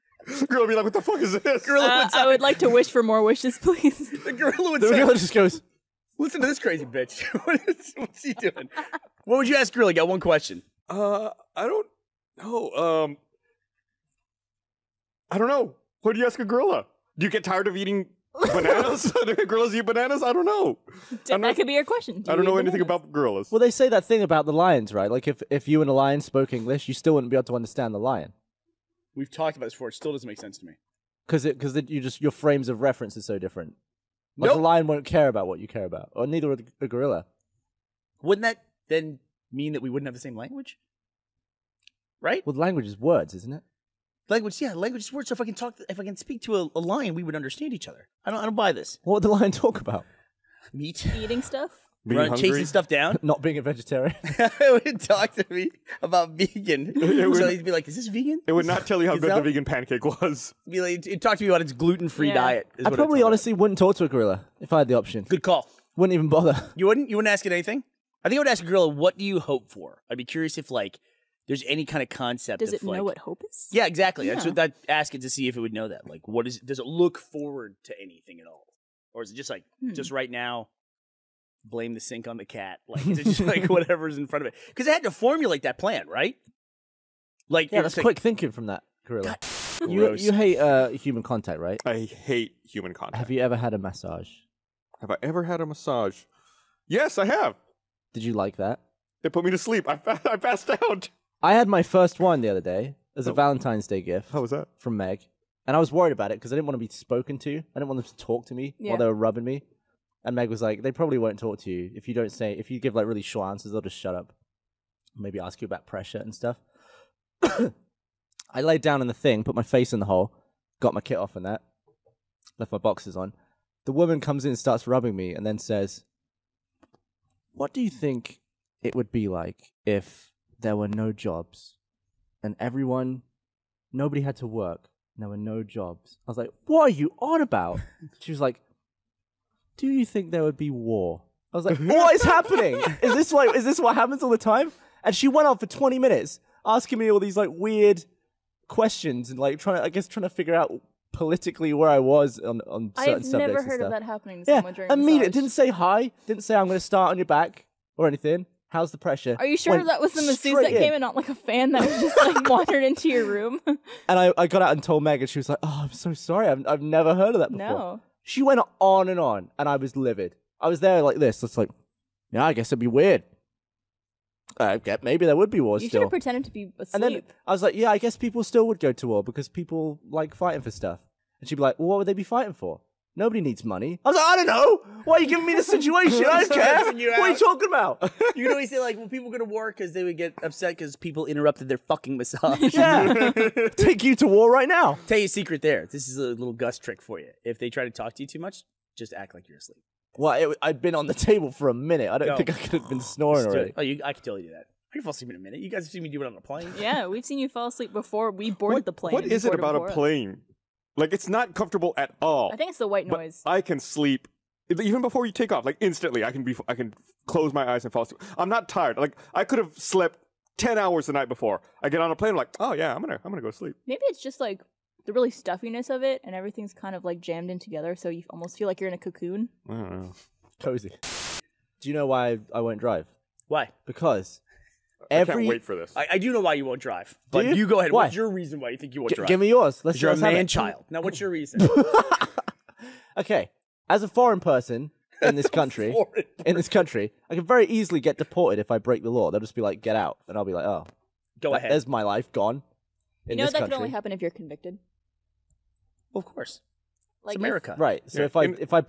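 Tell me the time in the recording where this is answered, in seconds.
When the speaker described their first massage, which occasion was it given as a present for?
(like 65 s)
103 s.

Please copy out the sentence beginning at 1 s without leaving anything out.
Uh, I would like to wish for more wishes, please.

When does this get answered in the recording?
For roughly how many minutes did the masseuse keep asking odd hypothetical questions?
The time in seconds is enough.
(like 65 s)
145 s.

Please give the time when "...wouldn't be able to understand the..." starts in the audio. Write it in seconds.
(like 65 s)
27 s.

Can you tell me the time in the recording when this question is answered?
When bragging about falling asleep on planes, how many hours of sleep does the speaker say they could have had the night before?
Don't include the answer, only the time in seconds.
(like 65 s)
220 s.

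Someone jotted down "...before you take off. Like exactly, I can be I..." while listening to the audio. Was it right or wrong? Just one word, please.
wrong.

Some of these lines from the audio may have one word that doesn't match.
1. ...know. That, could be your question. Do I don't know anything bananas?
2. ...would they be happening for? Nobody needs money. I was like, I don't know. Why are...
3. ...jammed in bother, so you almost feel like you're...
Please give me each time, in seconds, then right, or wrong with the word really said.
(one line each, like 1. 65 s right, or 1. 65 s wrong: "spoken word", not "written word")
1. 20 s right
2. 181 s wrong: "fighting", not "happening"
3. 227 s wrong: "together", not "bother".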